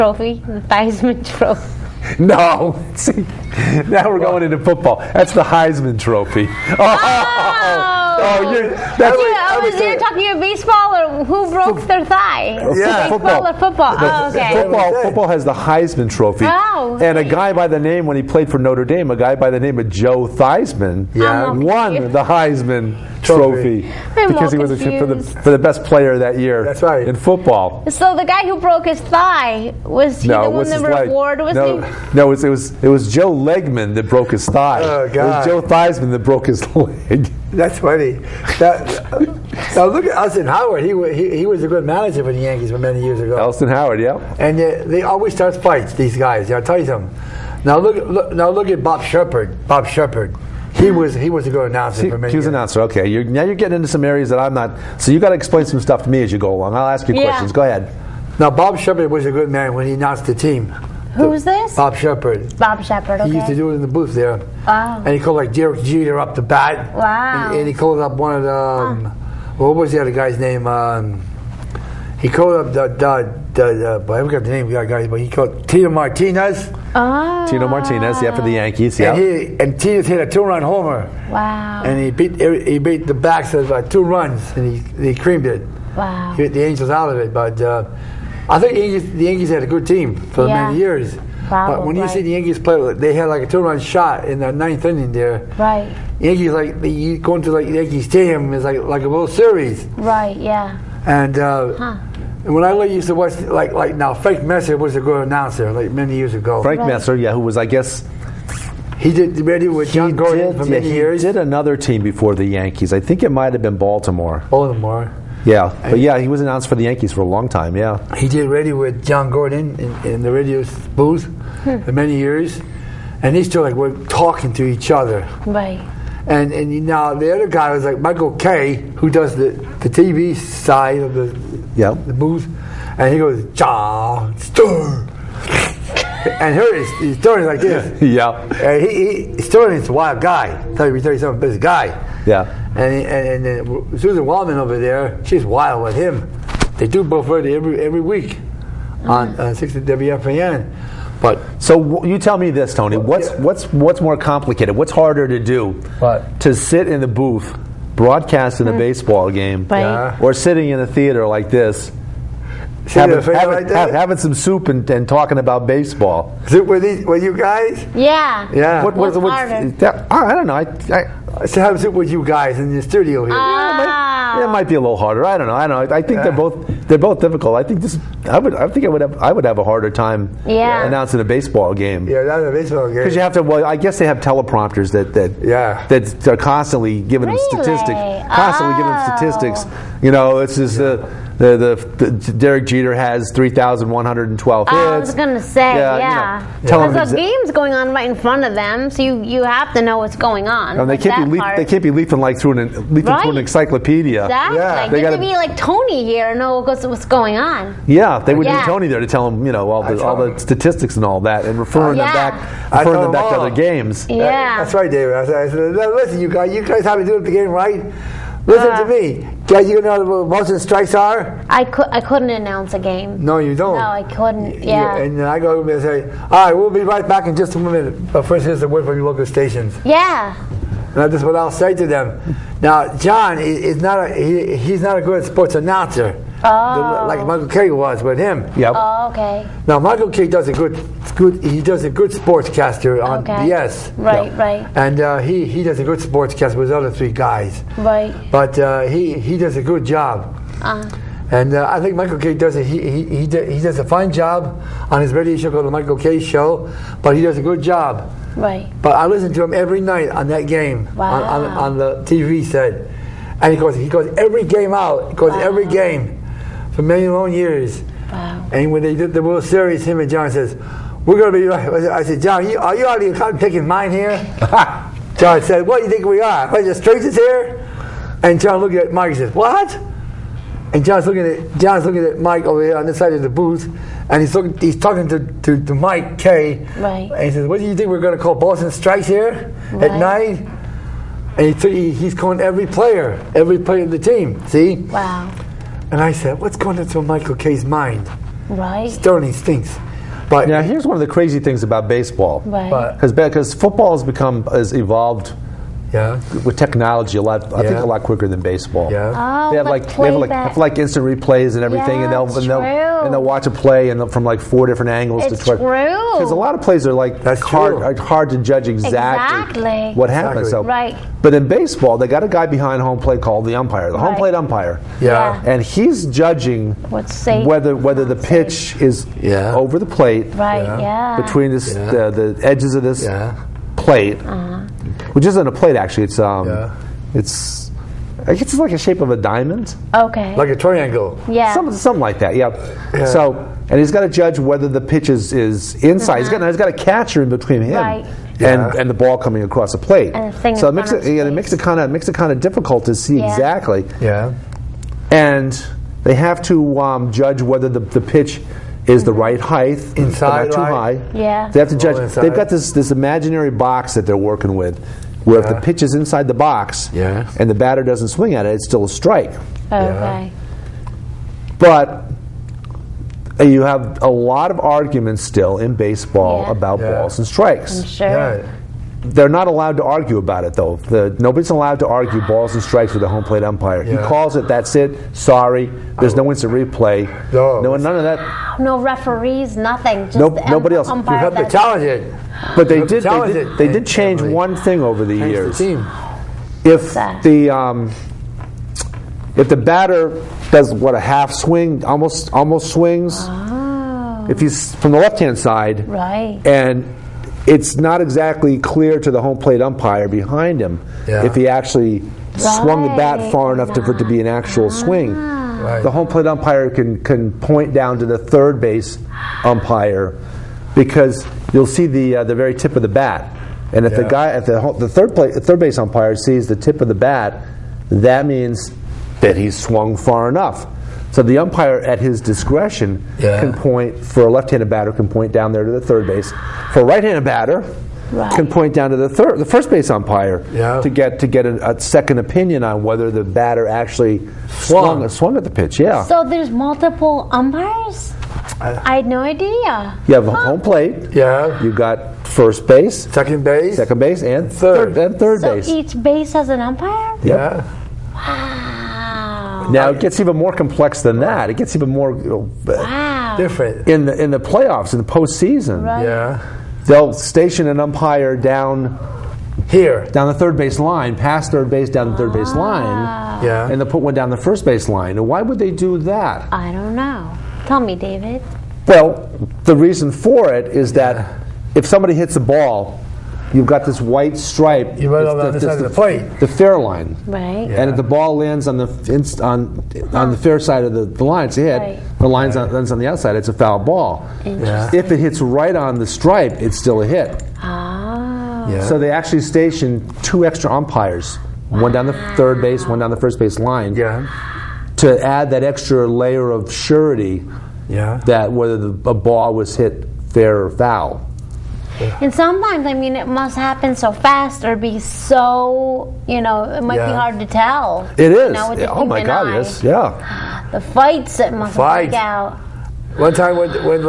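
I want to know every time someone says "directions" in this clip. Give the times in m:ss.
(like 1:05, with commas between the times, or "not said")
not said.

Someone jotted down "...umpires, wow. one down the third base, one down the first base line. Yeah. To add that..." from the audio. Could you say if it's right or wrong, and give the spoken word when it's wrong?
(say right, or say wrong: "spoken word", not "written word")
right.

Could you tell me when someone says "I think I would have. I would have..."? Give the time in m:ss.
2:58.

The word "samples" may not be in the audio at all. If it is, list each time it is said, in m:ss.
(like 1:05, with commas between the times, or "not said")
not said.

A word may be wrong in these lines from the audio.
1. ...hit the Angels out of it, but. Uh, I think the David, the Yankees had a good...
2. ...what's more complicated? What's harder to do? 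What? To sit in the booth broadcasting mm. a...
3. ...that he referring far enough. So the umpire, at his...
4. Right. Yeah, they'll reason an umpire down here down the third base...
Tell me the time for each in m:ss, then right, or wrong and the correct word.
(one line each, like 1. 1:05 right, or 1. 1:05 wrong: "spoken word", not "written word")
1. 1:26 wrong: "Yankees", not "David"
2. 2:33 right
3. 7:09 wrong: "swung", not "referring"
4. 7:45 wrong: "station", not "reason".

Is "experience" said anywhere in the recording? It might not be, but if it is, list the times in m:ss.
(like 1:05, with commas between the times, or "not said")
not said.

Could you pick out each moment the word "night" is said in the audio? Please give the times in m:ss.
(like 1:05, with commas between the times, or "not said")
4:19, 4:49.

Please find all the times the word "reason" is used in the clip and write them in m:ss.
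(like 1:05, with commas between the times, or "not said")
7:59.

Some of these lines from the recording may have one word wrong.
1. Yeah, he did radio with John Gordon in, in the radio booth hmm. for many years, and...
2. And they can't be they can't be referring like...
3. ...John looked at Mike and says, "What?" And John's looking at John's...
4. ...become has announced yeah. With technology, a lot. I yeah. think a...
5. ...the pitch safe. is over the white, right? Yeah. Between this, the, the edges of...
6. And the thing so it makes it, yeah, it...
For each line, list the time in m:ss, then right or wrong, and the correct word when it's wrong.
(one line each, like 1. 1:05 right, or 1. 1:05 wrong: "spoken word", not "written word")
1. 1:57 right
2. 3:20 wrong: "leafing", not "referring"
3. 4:38 right
4. 5:04 wrong: "evolved", not "announced"
5. 5:28 wrong: "plate", not "white"
6. 5:50 right.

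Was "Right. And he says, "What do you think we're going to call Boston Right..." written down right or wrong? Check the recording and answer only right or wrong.
wrong.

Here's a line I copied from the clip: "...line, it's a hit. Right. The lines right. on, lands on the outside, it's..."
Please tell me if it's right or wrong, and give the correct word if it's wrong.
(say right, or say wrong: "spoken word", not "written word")
right.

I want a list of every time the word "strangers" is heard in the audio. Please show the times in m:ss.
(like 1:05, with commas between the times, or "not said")
4:36.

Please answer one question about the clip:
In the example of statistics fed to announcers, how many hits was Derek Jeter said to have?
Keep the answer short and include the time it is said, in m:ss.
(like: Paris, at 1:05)
3,112, at 3:13.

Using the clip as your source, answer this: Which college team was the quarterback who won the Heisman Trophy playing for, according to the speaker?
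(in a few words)
Notre Dame.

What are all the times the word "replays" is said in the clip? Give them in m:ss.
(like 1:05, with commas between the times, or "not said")
5:11, 6:26.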